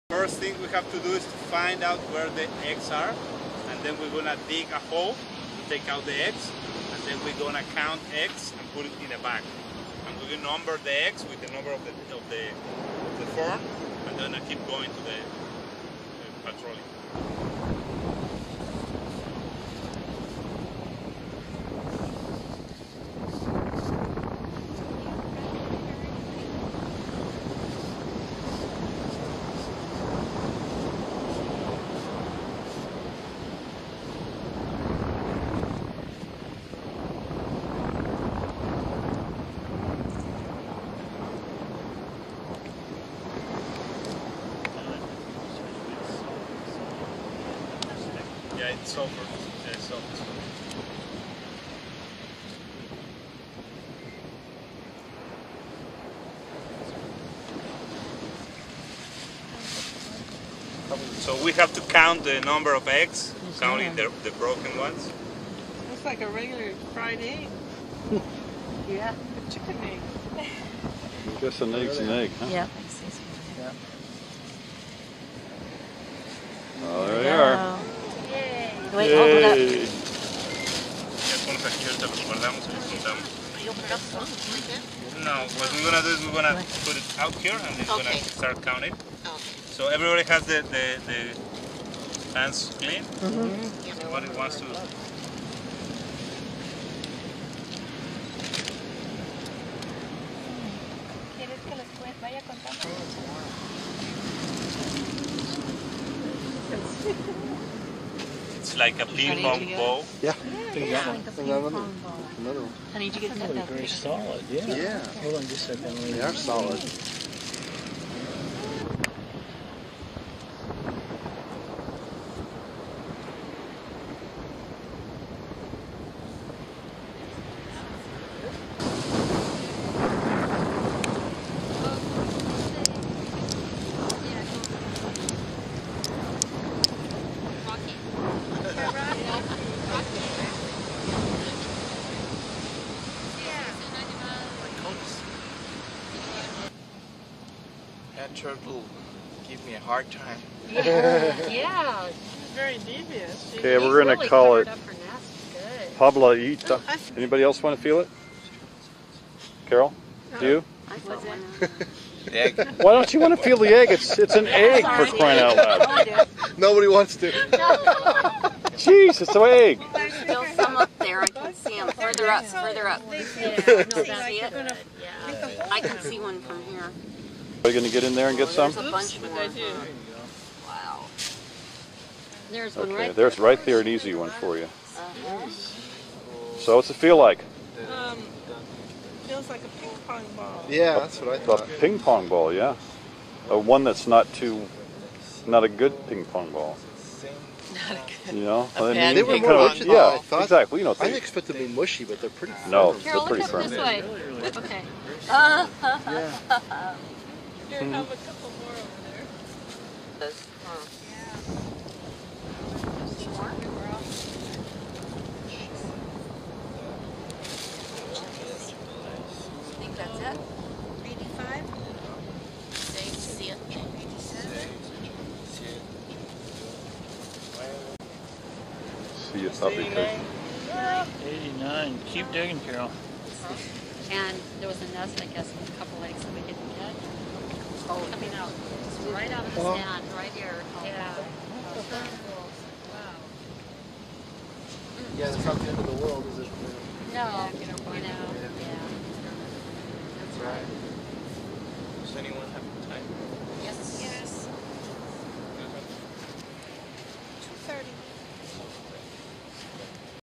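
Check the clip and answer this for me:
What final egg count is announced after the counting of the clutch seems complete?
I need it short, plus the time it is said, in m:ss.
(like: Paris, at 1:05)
89, at 3:51.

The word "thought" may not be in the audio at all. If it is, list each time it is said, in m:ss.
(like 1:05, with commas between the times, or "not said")
3:11, 3:20.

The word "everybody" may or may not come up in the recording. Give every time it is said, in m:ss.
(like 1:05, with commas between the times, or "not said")
1:29, 1:33.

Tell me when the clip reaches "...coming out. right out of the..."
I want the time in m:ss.
3:57.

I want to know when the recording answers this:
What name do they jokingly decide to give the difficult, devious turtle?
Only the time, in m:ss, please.
2:35.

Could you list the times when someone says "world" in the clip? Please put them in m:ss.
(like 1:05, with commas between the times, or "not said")
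4:06.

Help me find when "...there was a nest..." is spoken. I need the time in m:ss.
3:54.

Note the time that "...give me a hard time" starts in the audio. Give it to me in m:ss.
2:29.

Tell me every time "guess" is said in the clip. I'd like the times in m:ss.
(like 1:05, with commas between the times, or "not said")
1:11, 3:55.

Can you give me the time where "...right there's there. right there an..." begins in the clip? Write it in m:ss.
3:02.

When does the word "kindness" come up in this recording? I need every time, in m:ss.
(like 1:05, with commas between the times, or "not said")
not said.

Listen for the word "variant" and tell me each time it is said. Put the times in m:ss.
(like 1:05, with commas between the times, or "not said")
not said.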